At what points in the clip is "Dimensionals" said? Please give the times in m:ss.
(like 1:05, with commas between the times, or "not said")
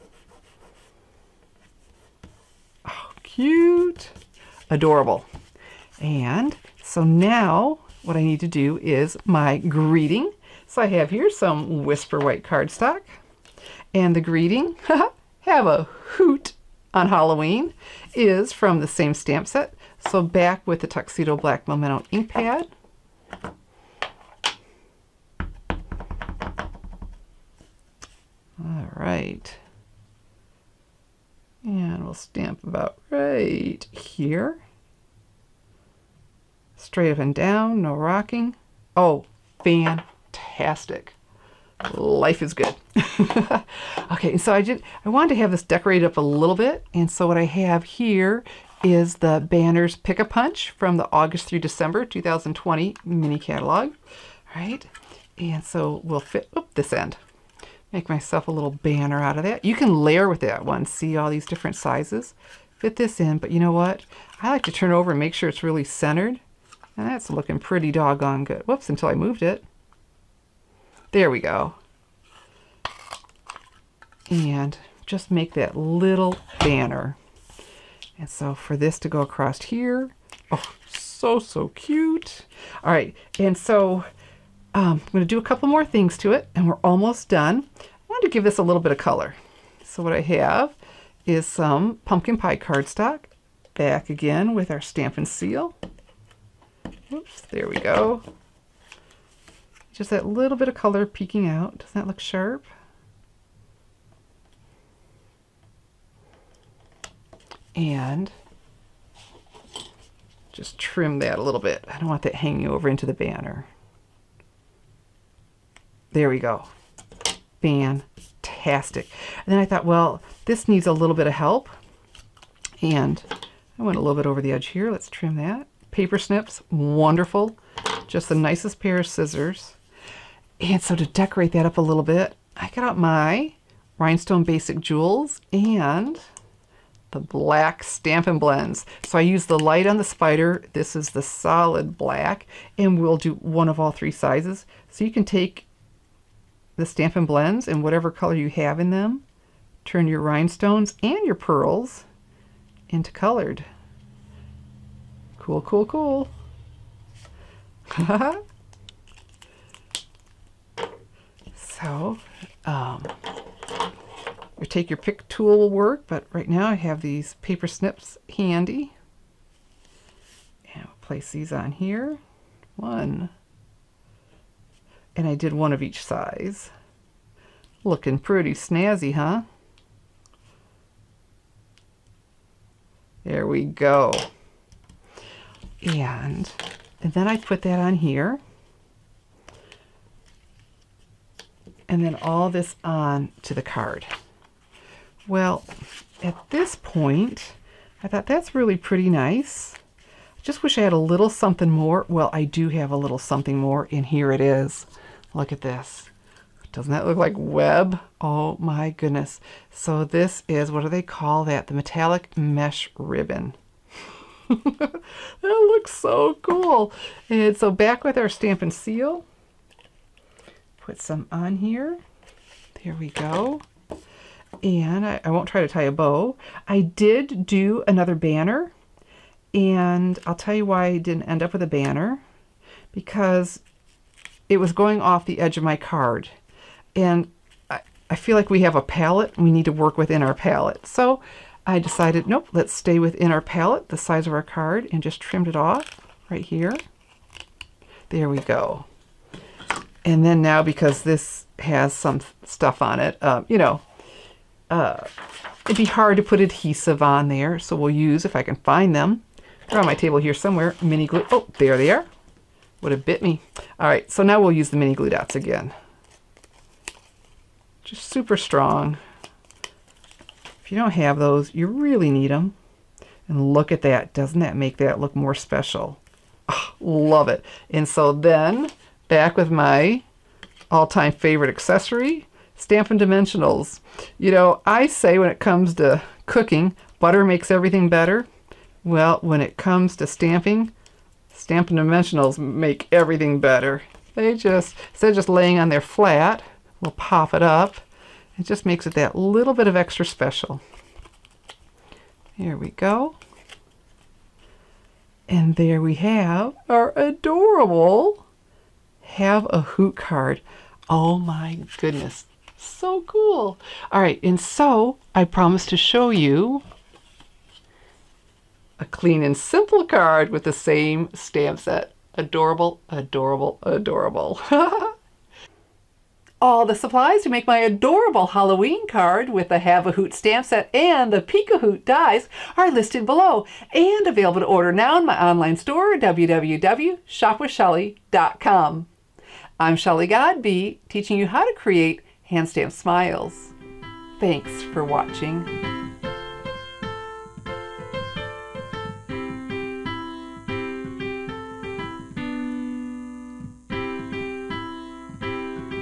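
4:42, 4:51.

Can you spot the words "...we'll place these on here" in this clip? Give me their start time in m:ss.
2:50.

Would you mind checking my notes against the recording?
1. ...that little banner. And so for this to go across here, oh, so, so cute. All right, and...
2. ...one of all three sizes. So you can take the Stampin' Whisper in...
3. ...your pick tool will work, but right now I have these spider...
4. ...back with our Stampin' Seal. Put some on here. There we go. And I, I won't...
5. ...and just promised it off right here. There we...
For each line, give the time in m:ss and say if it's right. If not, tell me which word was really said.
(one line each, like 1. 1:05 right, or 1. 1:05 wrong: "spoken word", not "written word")
1. 1:15 right
2. 2:23 wrong: "Blends", not "Whisper"
3. 2:44 wrong: "paper", not "spider"
4. 3:37 right
5. 4:04 wrong: "trimmed", not "promised".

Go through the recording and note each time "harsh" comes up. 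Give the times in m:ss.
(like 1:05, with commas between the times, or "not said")
not said.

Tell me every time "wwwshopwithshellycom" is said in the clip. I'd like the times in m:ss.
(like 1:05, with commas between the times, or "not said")
5:35.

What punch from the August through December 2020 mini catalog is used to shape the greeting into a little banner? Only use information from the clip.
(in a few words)
Banners Pick a Punch.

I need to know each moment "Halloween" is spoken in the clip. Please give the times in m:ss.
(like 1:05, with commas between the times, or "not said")
0:17, 5:28.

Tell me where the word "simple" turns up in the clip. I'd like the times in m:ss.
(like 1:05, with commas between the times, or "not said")
5:19.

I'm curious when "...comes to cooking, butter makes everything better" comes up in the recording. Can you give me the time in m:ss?
4:45.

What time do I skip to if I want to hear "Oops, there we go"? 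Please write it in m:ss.
1:37.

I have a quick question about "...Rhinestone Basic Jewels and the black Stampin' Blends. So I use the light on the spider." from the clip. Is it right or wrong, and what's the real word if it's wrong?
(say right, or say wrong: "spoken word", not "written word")
right.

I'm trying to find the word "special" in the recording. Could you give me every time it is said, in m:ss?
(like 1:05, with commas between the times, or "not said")
4:35, 5:00.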